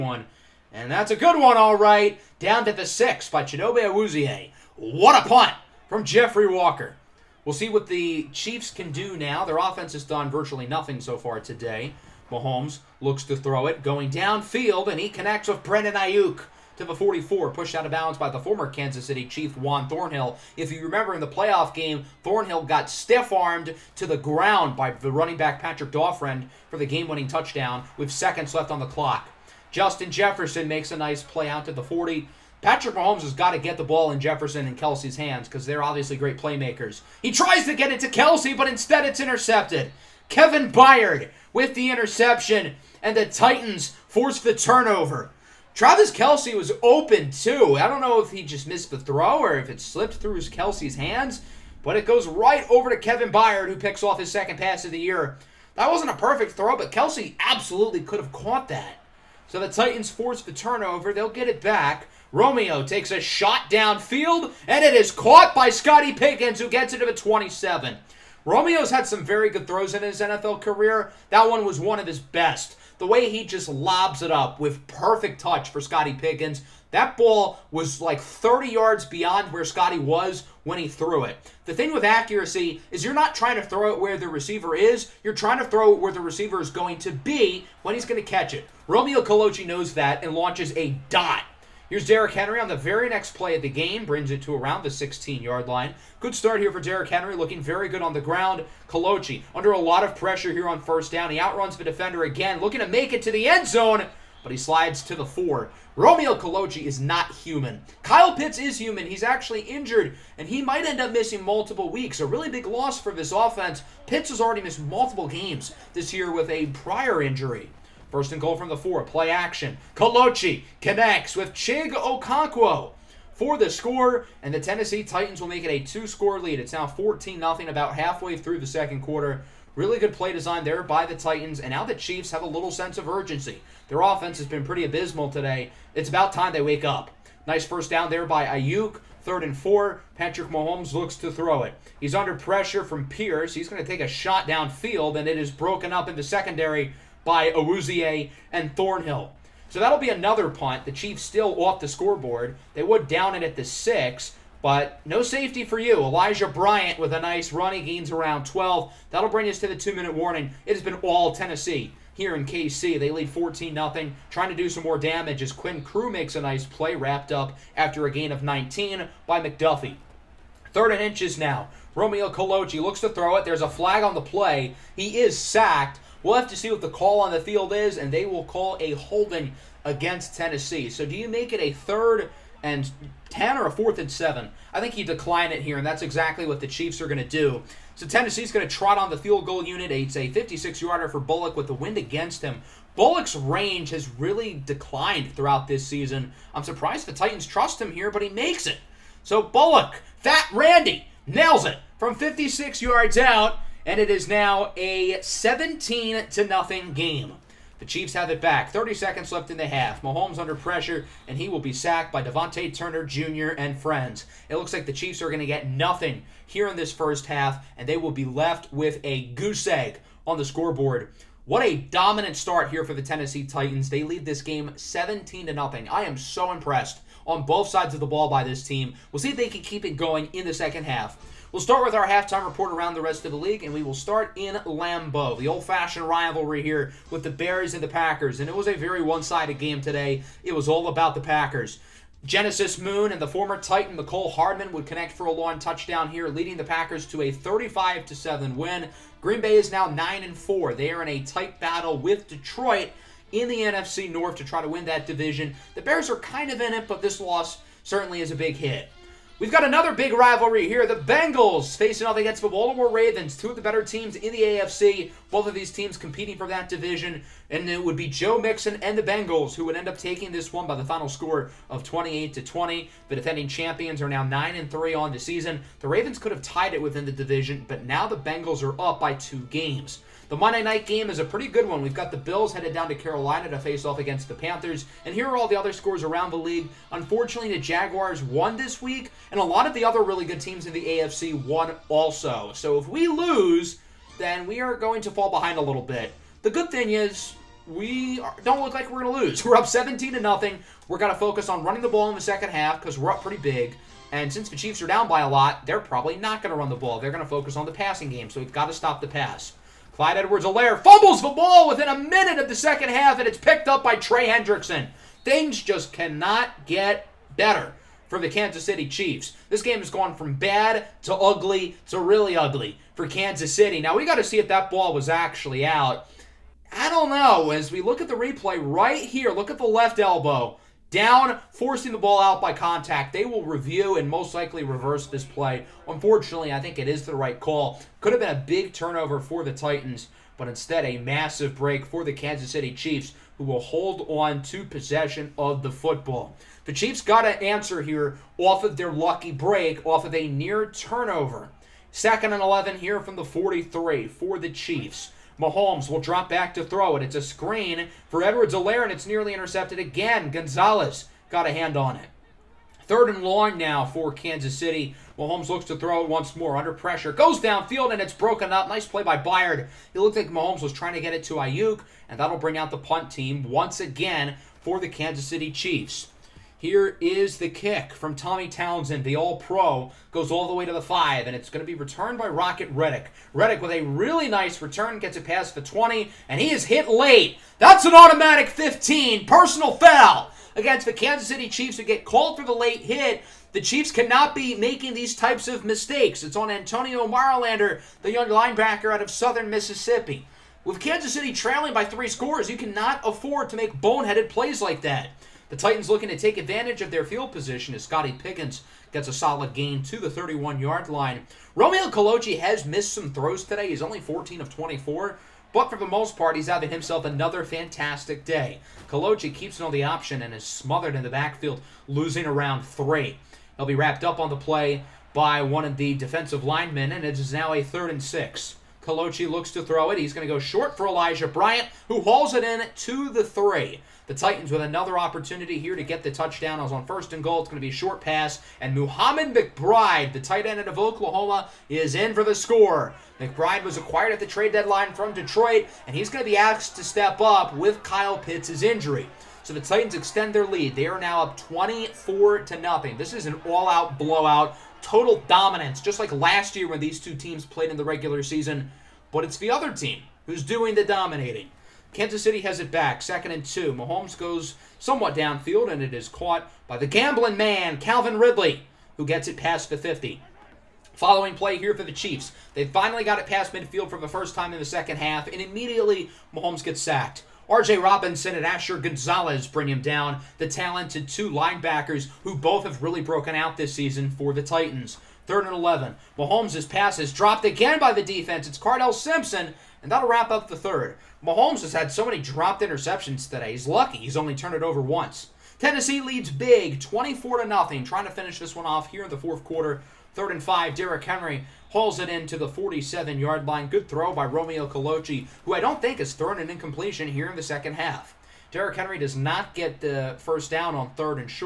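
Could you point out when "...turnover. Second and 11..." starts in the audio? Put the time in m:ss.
5:50.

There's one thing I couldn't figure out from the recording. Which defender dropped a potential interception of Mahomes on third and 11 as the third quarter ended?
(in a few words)
Cardell Simpson.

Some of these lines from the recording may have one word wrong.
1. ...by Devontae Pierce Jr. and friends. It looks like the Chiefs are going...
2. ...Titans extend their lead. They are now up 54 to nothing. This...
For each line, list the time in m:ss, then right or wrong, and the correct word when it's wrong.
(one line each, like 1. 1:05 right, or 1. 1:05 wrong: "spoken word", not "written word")
1. 3:32 wrong: "Turner", not "Pierce"
2. 7:29 wrong: "24", not "54".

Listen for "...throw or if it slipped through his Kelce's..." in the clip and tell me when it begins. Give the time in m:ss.
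0:48.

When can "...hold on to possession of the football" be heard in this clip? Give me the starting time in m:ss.
5:43.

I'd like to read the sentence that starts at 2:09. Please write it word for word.
Really good play design there by the Titans, and now the Chiefs have a little sense of urgency.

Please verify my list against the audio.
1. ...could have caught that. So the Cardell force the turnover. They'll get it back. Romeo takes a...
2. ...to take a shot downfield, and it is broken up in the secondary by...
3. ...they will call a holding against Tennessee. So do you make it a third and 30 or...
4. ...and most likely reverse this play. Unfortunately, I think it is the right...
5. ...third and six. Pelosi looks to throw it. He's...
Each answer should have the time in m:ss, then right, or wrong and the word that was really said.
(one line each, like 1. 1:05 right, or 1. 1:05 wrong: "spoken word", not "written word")
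1. 0:58 wrong: "Titans", not "Cardell"
2. 2:23 right
3. 2:58 wrong: "10", not "30"
4. 5:33 right
5. 7:07 right.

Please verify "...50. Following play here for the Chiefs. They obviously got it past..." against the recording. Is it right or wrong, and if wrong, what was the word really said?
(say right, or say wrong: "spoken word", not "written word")
wrong: "finally", not "obviously".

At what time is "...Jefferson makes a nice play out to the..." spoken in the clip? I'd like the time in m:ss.
0:30.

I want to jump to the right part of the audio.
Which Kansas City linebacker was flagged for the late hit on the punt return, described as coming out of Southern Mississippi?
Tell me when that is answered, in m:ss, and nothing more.
6:36.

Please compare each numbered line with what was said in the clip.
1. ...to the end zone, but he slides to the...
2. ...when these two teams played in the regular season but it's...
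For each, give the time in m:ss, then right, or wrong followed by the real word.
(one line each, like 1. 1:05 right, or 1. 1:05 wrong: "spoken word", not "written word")
1. 1:43 right
2. 7:36 right.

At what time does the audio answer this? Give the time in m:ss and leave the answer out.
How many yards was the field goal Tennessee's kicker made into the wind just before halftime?
3:10.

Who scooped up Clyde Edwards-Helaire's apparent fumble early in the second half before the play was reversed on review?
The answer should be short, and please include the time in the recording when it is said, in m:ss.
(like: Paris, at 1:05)
Trey Hendrickson, at 5:13.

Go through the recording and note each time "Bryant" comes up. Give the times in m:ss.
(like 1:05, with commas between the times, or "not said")
2:36, 7:11.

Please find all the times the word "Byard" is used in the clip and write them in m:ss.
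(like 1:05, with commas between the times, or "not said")
0:40, 0:53, 6:09.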